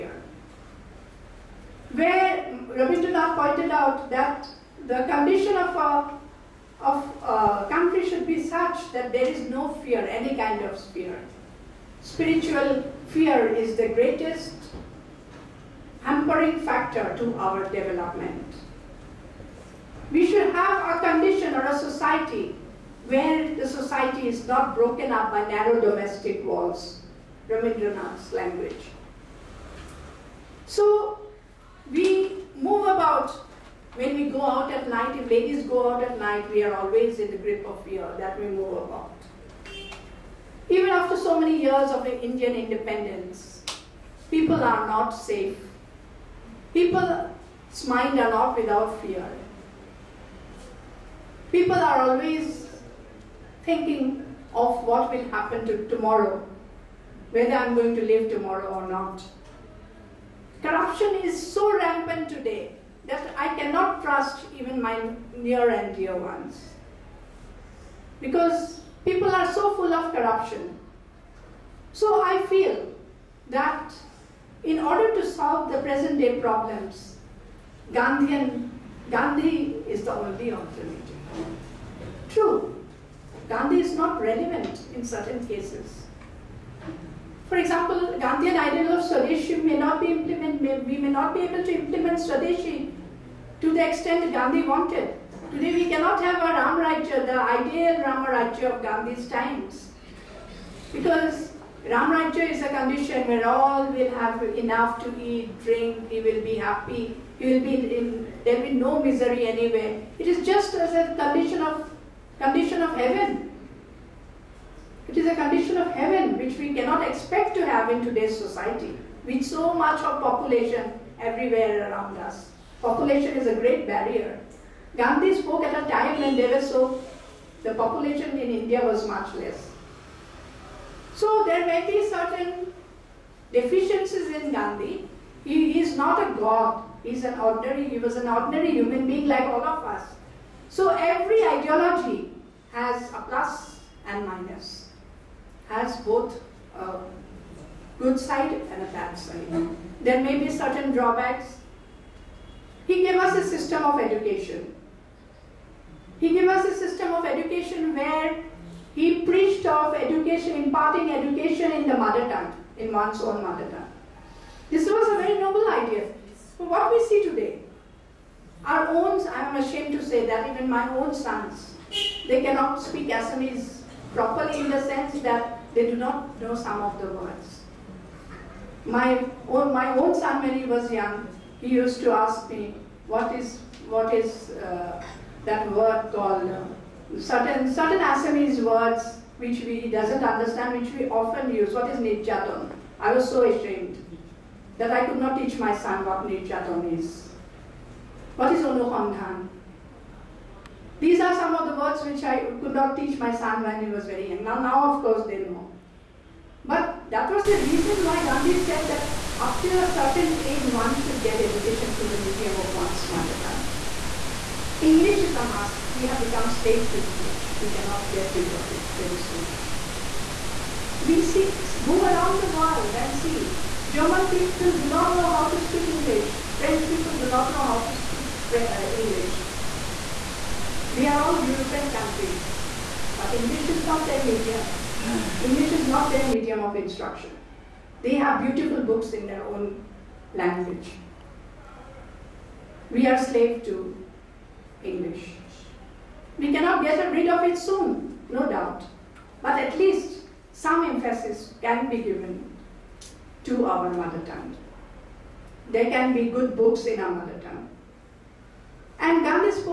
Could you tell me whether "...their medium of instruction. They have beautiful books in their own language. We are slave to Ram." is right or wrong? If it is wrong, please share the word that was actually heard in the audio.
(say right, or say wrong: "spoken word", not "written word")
wrong: "English", not "Ram".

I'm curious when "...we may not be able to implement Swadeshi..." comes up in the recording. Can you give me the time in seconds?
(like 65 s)
90 s.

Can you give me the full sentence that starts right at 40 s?
Even after so many years of Indian independence, people are not safe.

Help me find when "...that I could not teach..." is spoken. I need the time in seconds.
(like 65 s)
194 s.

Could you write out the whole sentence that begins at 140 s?
So every ideology has a plus and minus, has both a good side and a bad side.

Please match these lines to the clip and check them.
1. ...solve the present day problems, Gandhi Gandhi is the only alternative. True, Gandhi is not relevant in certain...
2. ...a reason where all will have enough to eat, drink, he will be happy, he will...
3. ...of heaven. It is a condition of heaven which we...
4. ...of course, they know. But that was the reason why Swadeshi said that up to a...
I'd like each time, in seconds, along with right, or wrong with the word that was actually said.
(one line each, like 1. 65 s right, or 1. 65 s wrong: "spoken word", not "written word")
1. 75 s right
2. 102 s wrong: "condition", not "reason"
3. 112 s right
4. 204 s wrong: "Gandhi", not "Swadeshi".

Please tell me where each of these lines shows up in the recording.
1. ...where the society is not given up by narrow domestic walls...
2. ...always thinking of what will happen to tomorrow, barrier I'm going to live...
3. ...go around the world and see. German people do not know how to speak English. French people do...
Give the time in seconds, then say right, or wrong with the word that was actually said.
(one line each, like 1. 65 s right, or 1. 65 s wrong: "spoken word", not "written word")
1. 23 s wrong: "broken", not "given"
2. 52 s wrong: "whether", not "barrier"
3. 221 s right.